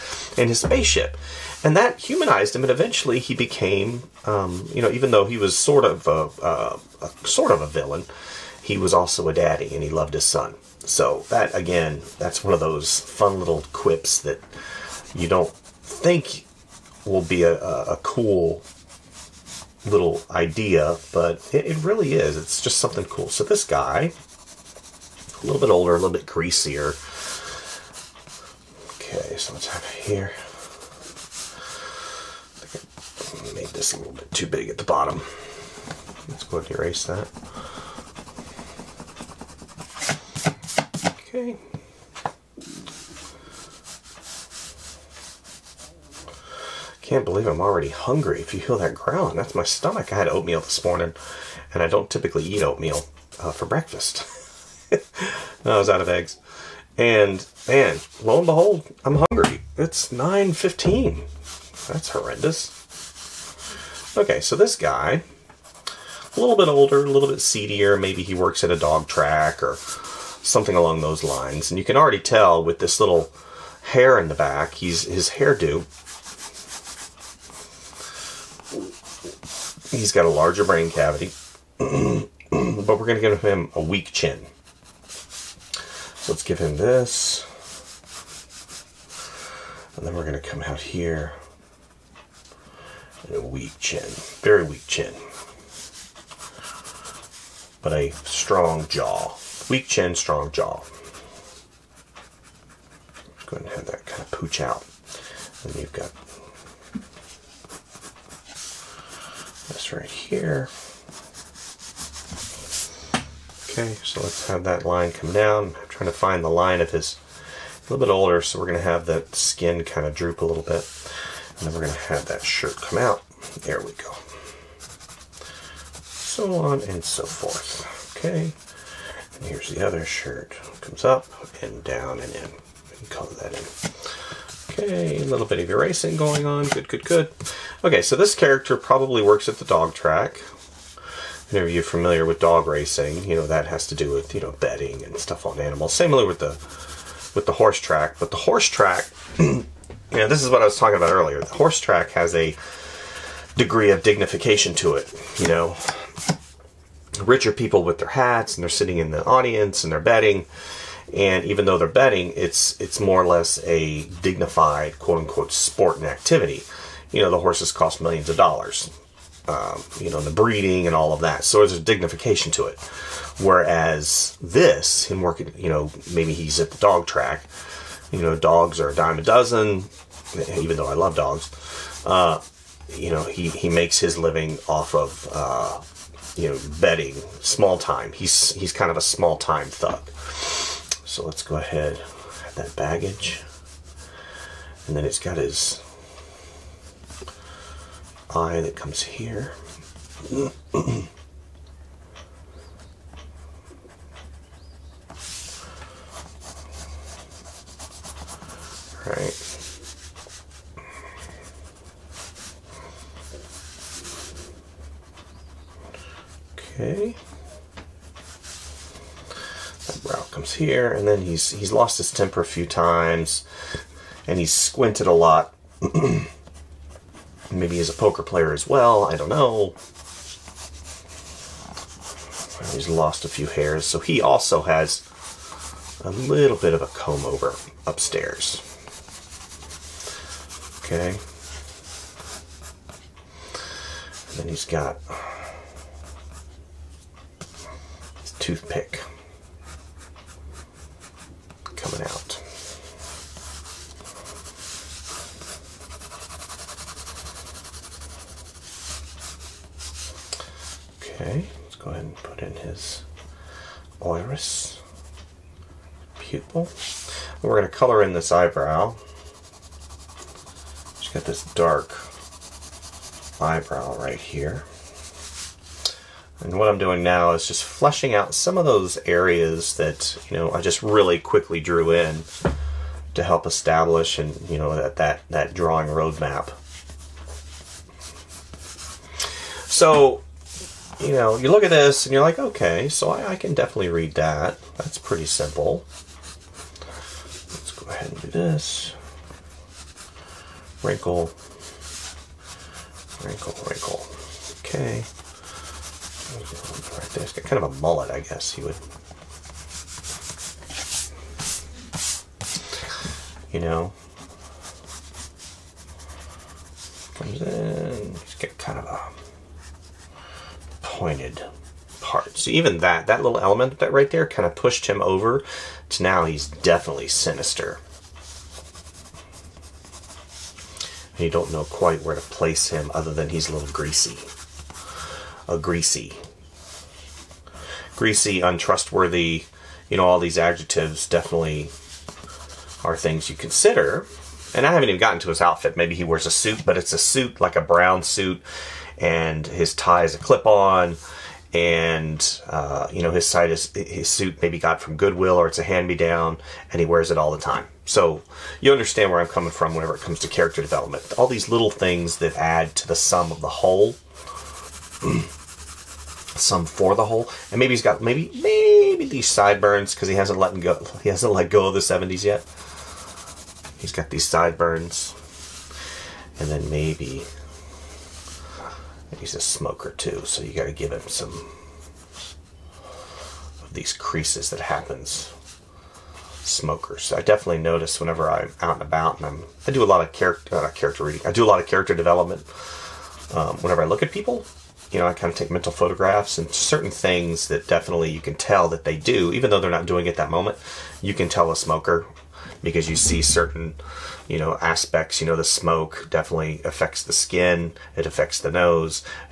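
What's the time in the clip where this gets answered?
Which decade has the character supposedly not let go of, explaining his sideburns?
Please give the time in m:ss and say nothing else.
6:11.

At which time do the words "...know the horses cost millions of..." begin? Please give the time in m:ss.
2:47.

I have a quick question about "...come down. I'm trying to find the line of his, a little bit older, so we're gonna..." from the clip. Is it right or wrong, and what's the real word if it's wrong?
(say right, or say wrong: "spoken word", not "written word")
right.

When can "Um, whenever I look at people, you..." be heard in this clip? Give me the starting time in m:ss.
6:33.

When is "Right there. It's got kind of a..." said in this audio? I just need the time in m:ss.
5:06.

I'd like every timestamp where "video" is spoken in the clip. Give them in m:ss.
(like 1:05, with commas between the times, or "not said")
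not said.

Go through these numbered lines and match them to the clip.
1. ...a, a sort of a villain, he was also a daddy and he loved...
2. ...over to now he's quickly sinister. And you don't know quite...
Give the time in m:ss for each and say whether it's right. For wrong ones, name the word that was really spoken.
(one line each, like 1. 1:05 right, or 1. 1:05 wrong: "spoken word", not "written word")
1. 0:06 right
2. 5:25 wrong: "definitely", not "quickly".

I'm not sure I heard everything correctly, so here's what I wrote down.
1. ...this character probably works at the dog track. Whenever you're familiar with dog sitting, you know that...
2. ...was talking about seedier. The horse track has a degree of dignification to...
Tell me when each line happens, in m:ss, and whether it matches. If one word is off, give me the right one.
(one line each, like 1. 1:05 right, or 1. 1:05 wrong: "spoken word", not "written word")
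1. 2:18 wrong: "racing", not "sitting"
2. 2:30 wrong: "earlier", not "seedier".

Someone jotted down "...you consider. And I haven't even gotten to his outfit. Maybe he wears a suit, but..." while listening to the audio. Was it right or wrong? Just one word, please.
right.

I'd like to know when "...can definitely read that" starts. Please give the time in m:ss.
4:53.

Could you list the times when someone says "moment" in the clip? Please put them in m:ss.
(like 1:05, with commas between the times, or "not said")
6:40.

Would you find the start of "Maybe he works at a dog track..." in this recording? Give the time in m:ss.
1:07.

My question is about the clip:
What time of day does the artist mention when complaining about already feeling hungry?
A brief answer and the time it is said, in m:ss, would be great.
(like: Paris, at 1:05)
9:15, at 1:00.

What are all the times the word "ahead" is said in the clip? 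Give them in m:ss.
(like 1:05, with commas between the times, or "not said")
0:36, 1:43, 3:11, 4:57.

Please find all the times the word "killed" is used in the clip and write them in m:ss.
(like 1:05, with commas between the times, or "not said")
not said.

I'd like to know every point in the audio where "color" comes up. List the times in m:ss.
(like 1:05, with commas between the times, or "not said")
2:13, 4:27.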